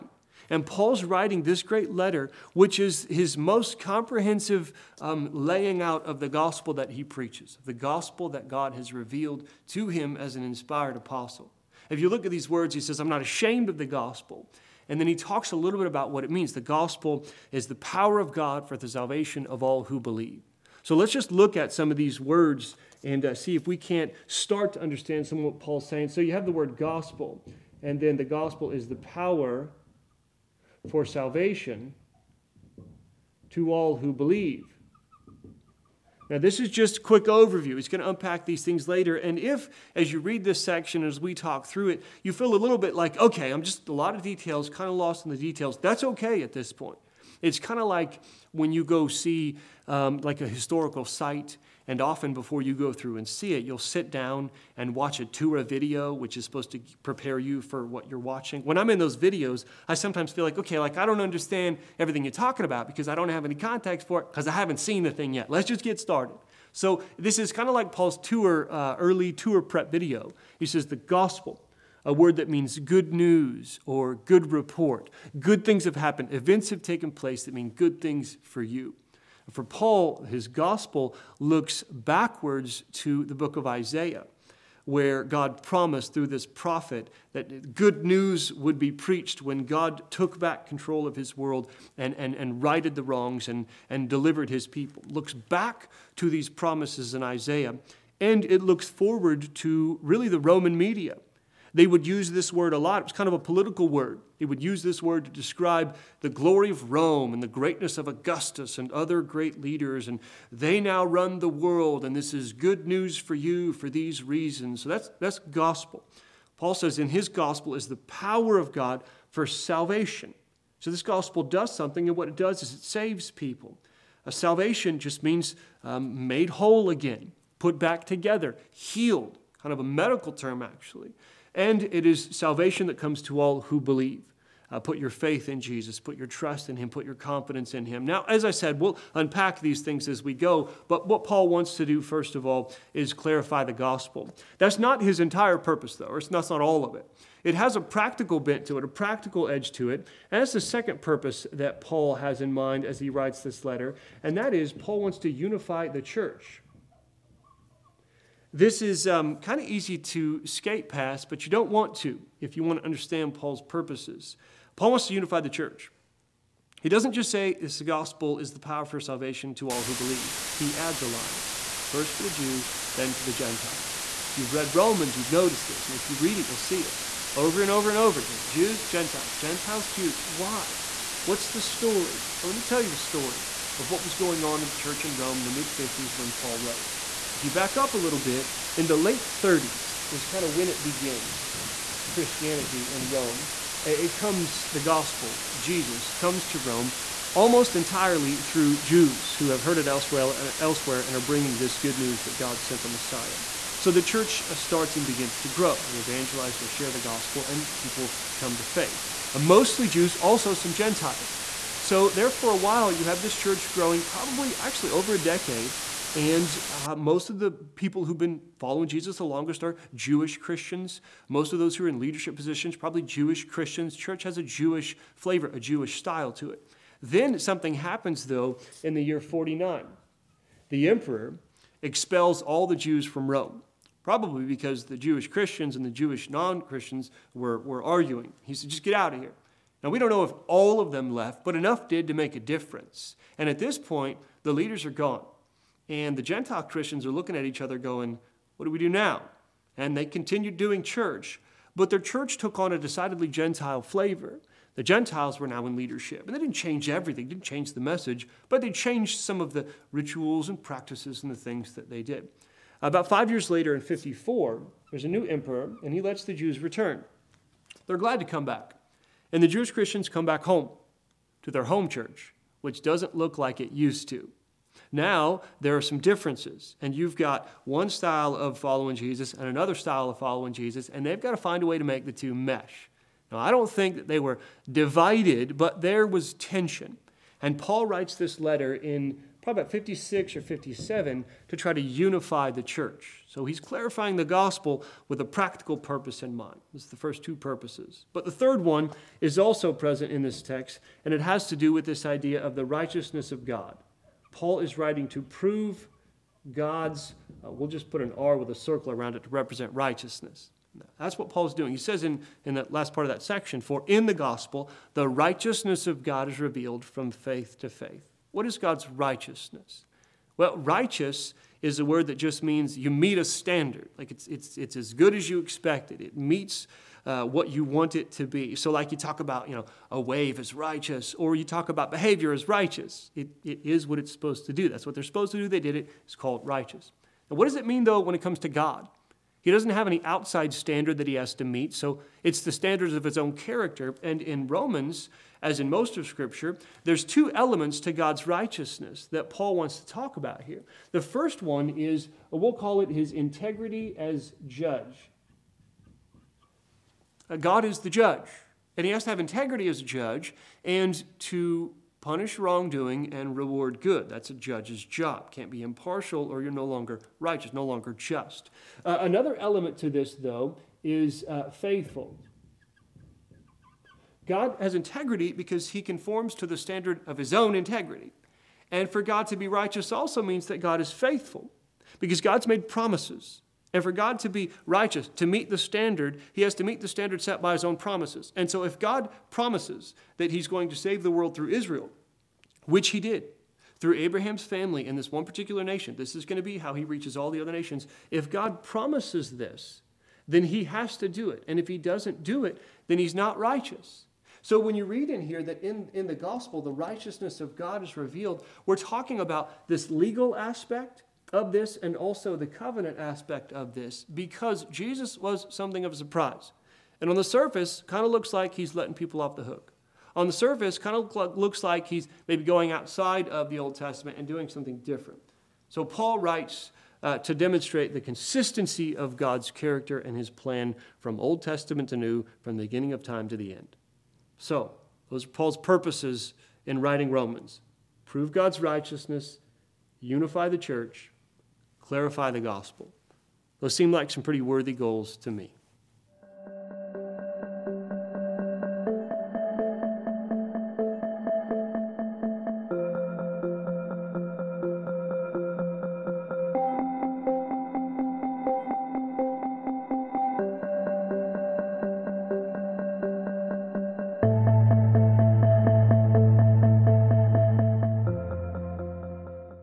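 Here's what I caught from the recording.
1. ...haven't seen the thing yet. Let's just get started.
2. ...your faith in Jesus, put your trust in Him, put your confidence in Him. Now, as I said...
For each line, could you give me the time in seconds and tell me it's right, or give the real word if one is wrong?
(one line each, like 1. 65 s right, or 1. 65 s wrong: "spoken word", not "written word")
1. 64 s right
2. 134 s right.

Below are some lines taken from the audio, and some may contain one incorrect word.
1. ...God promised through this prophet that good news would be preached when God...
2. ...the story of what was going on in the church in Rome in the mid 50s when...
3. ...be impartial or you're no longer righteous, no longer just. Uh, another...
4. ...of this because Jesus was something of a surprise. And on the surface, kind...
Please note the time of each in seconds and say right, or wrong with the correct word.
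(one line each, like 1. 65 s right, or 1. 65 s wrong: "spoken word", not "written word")
1. 85 s right
2. 182 s right
3. 365 s right
4. 413 s right.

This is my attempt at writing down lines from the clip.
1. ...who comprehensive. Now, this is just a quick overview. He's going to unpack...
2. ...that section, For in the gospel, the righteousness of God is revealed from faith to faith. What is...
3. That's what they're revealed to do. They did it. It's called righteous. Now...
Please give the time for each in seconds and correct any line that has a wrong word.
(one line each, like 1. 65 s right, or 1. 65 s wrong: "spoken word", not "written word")
1. 33 s wrong: "believe", not "comprehensive"
2. 313 s right
3. 334 s wrong: "supposed", not "revealed".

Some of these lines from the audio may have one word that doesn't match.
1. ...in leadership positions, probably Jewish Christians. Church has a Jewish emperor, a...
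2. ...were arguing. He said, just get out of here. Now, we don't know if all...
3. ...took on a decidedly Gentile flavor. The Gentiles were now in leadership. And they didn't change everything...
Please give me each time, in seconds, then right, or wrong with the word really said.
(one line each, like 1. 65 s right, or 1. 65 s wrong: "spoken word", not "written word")
1. 221 s wrong: "flavor", not "emperor"
2. 237 s right
3. 252 s right.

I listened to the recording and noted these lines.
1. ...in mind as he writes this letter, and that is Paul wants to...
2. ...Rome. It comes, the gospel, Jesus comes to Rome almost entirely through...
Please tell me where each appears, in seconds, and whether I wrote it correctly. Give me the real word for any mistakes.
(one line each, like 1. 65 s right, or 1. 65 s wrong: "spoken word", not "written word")
1. 152 s right
2. 193 s right.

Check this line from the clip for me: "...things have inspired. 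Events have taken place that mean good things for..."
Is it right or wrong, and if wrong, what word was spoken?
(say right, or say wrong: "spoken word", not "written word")
wrong: "happened", not "inspired".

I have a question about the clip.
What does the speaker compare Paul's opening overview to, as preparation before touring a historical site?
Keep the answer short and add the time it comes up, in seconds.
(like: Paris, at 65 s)
tour prep video, at 69 s.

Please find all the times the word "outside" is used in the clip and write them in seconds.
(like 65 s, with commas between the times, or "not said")
340 s, 422 s.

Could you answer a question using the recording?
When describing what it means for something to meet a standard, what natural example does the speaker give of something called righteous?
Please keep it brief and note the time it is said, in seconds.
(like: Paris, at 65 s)
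a wave, at 329 s.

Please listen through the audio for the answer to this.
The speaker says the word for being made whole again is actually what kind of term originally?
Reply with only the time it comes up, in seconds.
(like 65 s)
129 s.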